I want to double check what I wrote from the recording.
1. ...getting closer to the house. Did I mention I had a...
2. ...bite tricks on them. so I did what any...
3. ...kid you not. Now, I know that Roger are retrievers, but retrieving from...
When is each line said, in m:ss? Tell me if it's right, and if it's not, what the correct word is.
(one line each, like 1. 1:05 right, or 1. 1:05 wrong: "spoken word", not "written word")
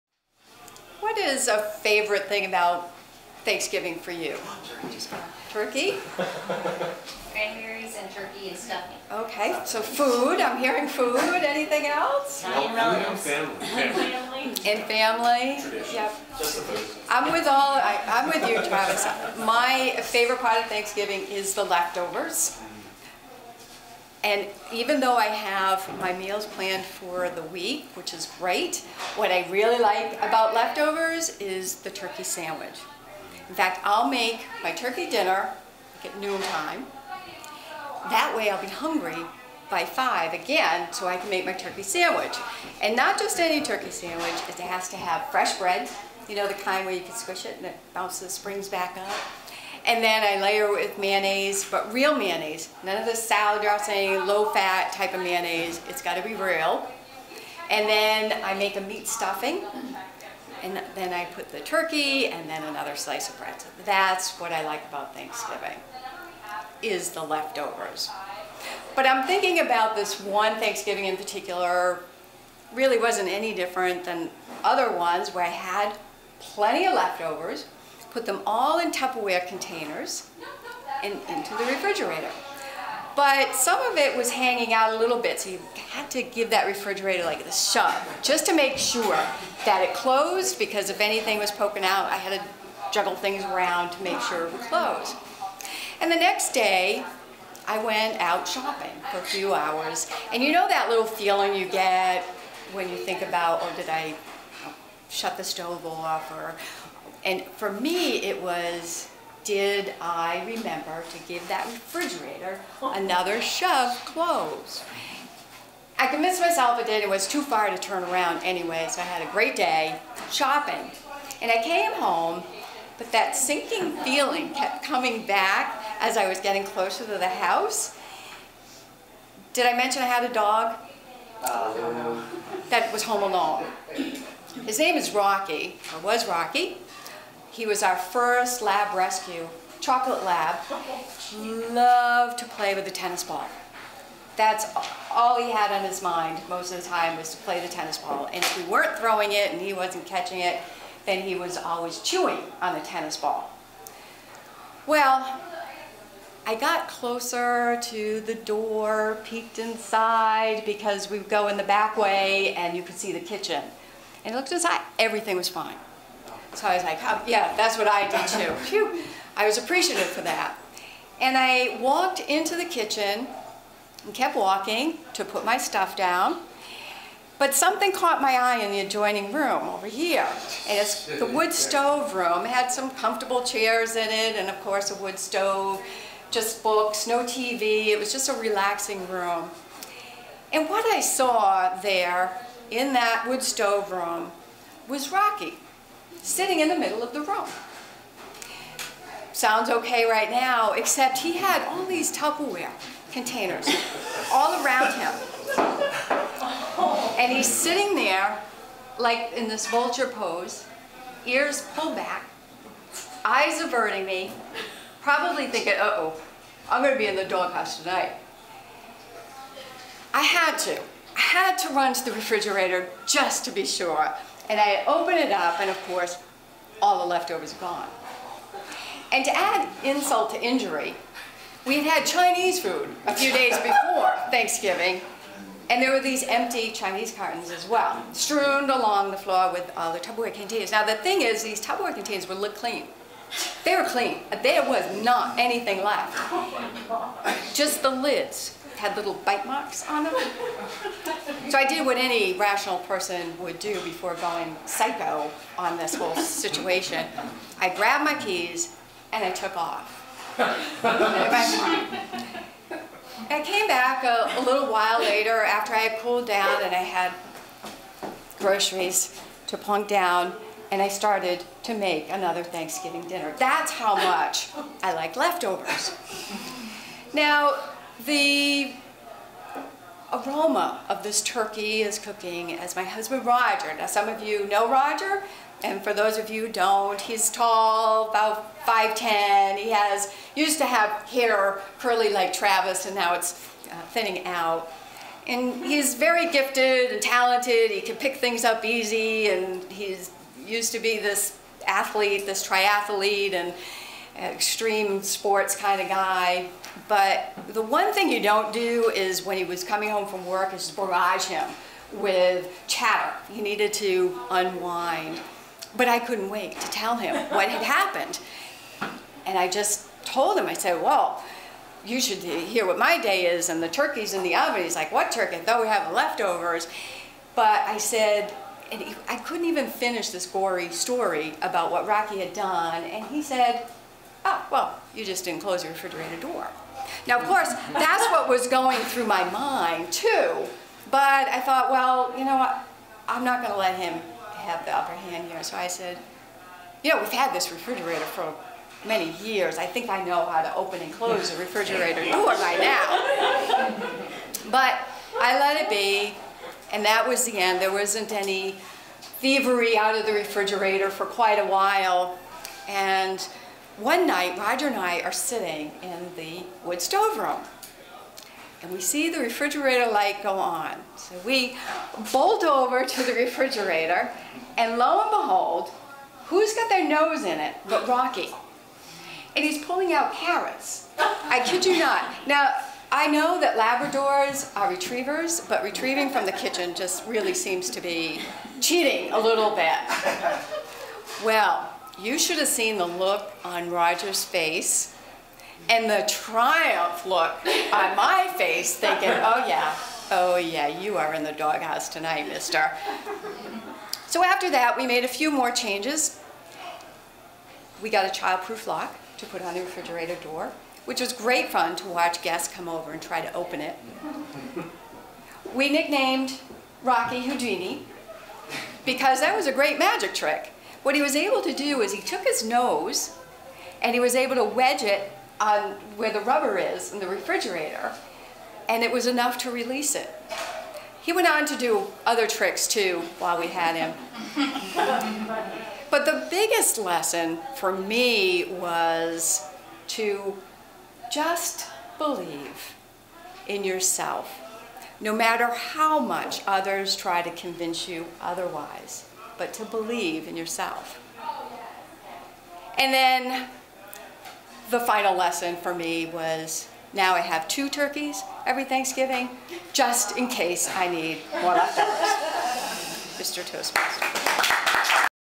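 1. 2:06 right
2. 4:09 wrong: "marks", not "tricks"
3. 6:21 wrong: "Labradors", not "Roger".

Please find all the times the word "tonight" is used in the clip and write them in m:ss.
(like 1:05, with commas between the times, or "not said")
3:37, 6:41.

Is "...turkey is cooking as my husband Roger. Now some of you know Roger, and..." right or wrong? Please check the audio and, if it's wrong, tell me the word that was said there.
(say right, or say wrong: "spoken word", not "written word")
right.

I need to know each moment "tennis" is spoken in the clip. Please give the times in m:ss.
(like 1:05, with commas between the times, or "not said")
2:22, 2:27, 2:32.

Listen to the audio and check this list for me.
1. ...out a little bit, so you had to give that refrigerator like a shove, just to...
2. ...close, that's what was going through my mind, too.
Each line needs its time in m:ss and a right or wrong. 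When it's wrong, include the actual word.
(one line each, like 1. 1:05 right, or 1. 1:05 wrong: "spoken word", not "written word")
1. 1:24 right
2. 5:37 wrong: "course", not "close".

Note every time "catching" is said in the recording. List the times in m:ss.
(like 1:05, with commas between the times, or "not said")
2:30.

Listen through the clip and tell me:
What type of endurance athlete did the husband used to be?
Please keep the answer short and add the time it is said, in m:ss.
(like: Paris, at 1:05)
triathlete, at 5:02.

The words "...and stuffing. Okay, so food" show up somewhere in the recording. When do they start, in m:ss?
0:08.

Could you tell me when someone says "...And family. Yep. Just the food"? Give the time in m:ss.
0:14.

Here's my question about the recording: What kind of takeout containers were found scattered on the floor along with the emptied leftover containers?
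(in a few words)
Chinese cartons.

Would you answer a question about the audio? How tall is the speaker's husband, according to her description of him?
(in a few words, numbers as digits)
5'10".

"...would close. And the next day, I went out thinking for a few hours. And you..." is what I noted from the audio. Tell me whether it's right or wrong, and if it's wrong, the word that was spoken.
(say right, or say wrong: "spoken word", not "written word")
wrong: "shopping", not "thinking".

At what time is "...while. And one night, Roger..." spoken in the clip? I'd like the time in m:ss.
6:01.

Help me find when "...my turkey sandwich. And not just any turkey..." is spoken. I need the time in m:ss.
0:41.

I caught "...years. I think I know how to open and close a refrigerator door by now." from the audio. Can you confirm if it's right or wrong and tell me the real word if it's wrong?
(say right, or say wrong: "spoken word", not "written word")
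right.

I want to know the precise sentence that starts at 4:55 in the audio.
And he's very gifted and talented.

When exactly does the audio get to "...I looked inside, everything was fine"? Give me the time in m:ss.
2:44.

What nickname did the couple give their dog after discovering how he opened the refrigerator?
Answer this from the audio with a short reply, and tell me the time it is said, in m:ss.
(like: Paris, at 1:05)
Houdini, at 6:57.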